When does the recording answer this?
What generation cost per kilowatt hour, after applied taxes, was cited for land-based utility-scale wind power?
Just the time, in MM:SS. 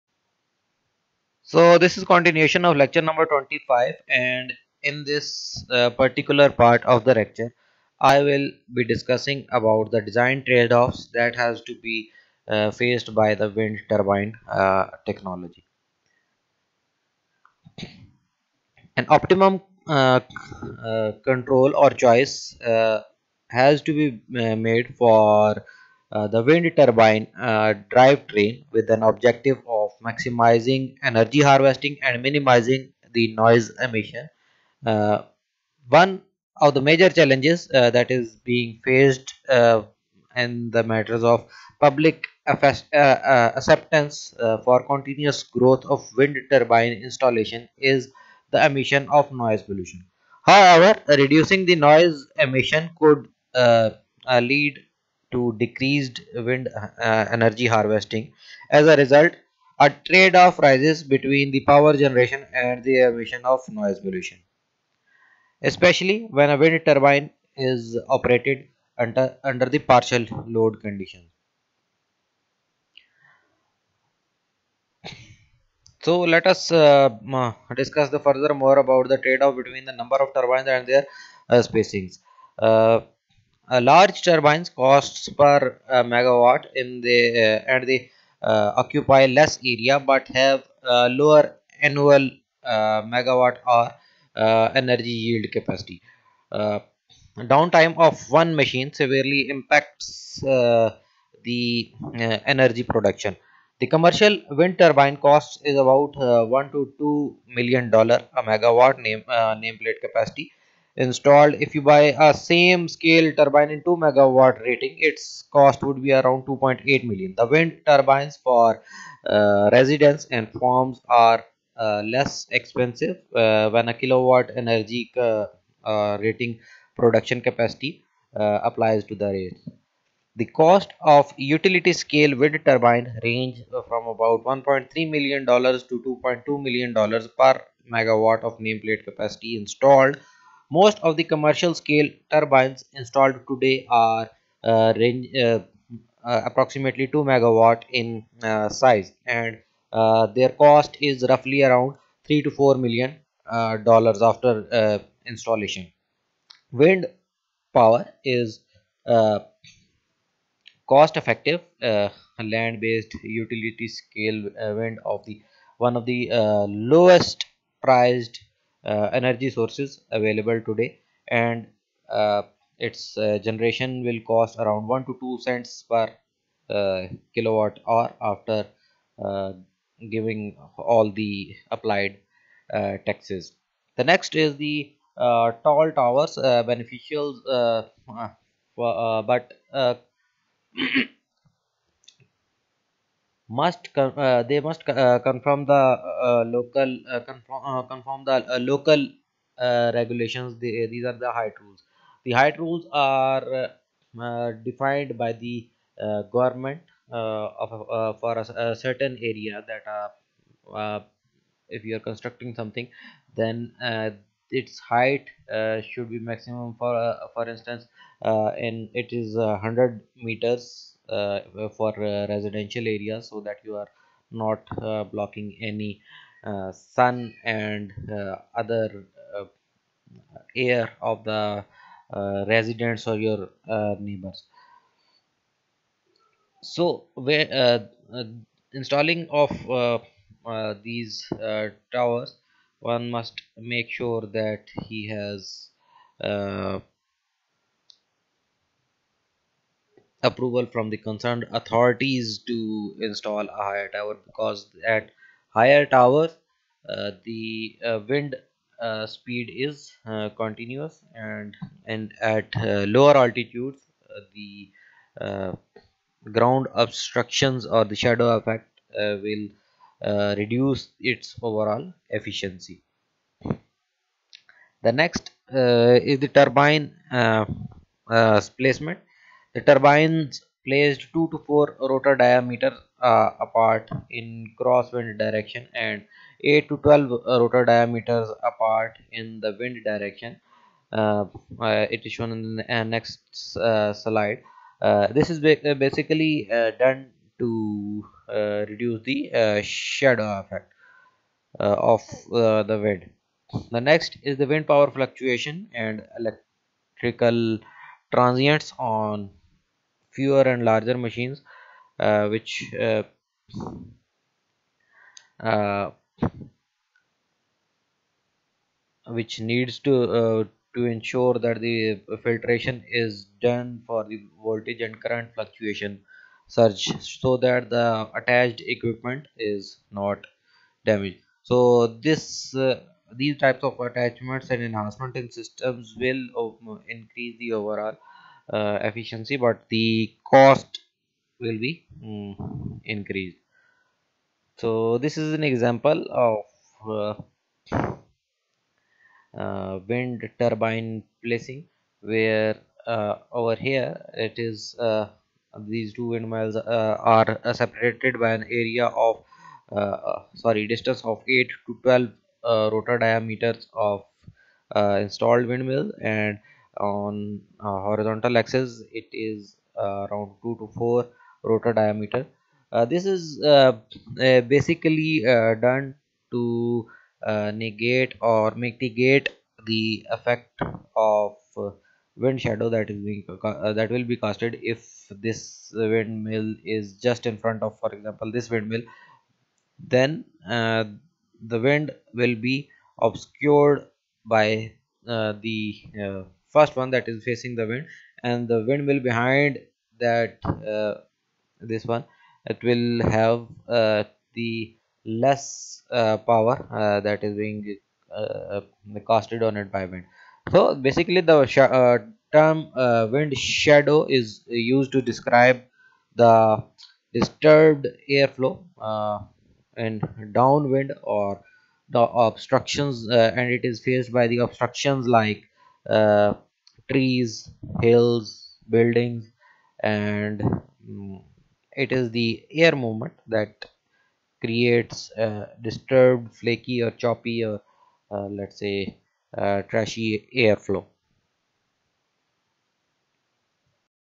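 02:54.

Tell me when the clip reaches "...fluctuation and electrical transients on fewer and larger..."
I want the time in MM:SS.
05:04.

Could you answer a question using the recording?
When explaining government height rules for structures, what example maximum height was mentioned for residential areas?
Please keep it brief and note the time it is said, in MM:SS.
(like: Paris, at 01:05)
100 meters, at 03:39.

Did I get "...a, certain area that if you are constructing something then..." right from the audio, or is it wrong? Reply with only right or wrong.
right.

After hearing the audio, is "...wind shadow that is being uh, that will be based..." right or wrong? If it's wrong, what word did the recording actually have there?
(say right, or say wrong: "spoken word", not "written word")
wrong: "casted", not "based".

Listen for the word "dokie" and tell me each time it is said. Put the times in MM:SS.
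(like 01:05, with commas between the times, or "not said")
not said.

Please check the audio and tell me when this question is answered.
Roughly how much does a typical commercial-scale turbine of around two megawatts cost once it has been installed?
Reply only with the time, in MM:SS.
02:32.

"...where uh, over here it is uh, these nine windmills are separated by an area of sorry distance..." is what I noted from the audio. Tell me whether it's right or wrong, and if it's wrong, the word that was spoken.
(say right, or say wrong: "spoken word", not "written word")
wrong: "two", not "nine".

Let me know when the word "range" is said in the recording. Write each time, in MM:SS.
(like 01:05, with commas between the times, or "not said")
02:13, 02:24.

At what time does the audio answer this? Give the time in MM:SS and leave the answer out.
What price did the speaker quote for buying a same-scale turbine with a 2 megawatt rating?
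01:56.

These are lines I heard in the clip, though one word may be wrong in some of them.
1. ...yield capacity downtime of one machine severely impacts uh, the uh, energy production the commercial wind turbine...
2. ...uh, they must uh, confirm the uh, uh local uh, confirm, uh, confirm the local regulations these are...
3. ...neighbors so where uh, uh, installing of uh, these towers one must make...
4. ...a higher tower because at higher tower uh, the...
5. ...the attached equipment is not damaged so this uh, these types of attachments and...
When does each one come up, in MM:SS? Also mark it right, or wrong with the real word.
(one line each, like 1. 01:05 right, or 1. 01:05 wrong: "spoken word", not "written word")
1. 01:35 right
2. 03:13 right
3. 03:53 right
4. 04:13 right
5. 05:27 right.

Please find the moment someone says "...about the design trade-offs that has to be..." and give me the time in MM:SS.
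00:09.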